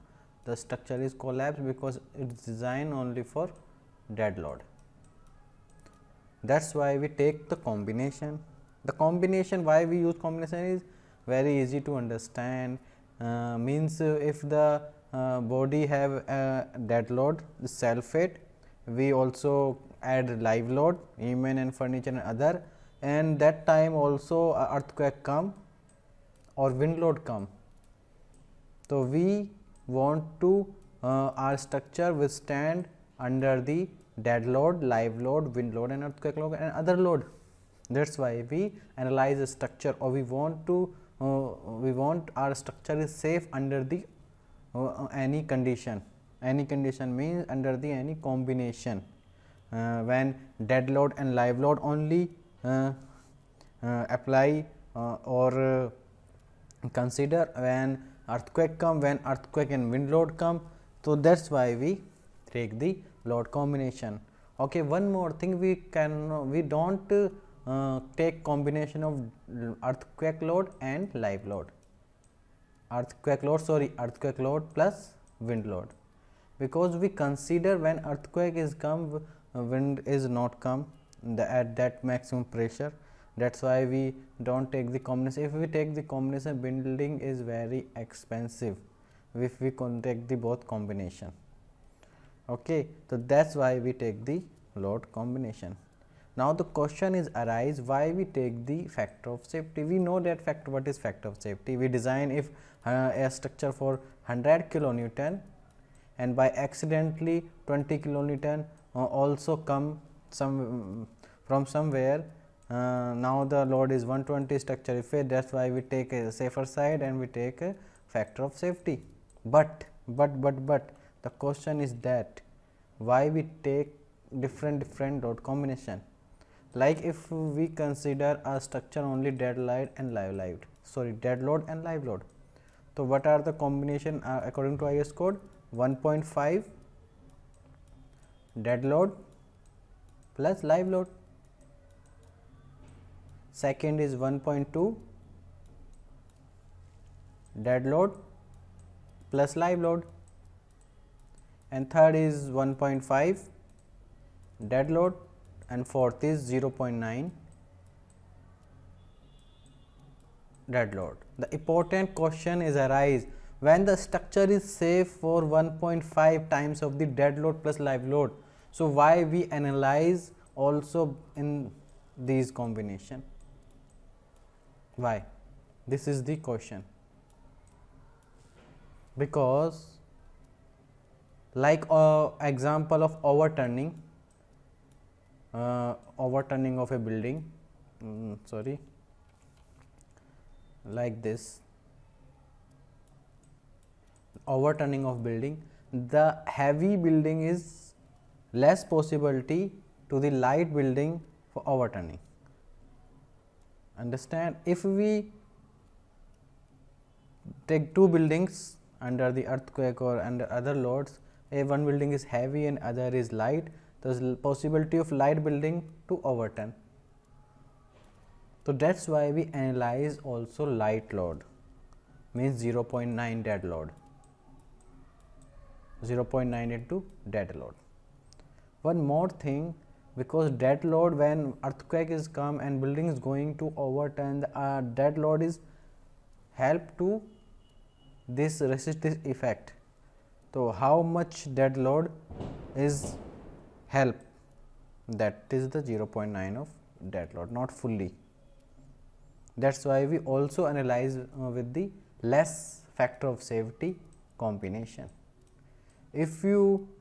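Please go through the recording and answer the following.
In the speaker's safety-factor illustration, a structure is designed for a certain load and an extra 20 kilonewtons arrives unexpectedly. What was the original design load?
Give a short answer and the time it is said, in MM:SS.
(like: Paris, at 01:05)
100 kilonewton, at 01:44.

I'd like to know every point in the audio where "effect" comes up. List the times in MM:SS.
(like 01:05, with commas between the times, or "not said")
01:54, 03:59.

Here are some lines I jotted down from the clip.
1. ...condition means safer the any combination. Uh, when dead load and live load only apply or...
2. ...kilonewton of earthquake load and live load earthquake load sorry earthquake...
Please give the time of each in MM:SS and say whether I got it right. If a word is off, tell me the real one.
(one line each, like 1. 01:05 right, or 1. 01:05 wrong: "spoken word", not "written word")
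1. 00:46 wrong: "under", not "safer"
2. 01:08 wrong: "combination", not "kilonewton".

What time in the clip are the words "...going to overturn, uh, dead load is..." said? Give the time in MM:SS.
03:53.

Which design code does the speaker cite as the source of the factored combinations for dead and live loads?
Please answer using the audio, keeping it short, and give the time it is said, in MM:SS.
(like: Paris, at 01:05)
IS code, at 02:14.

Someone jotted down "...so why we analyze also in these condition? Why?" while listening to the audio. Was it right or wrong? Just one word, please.
wrong.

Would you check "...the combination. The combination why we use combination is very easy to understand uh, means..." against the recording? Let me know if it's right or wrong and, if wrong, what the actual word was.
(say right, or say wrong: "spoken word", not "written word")
right.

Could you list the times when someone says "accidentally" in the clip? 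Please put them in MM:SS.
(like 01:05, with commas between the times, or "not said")
01:46.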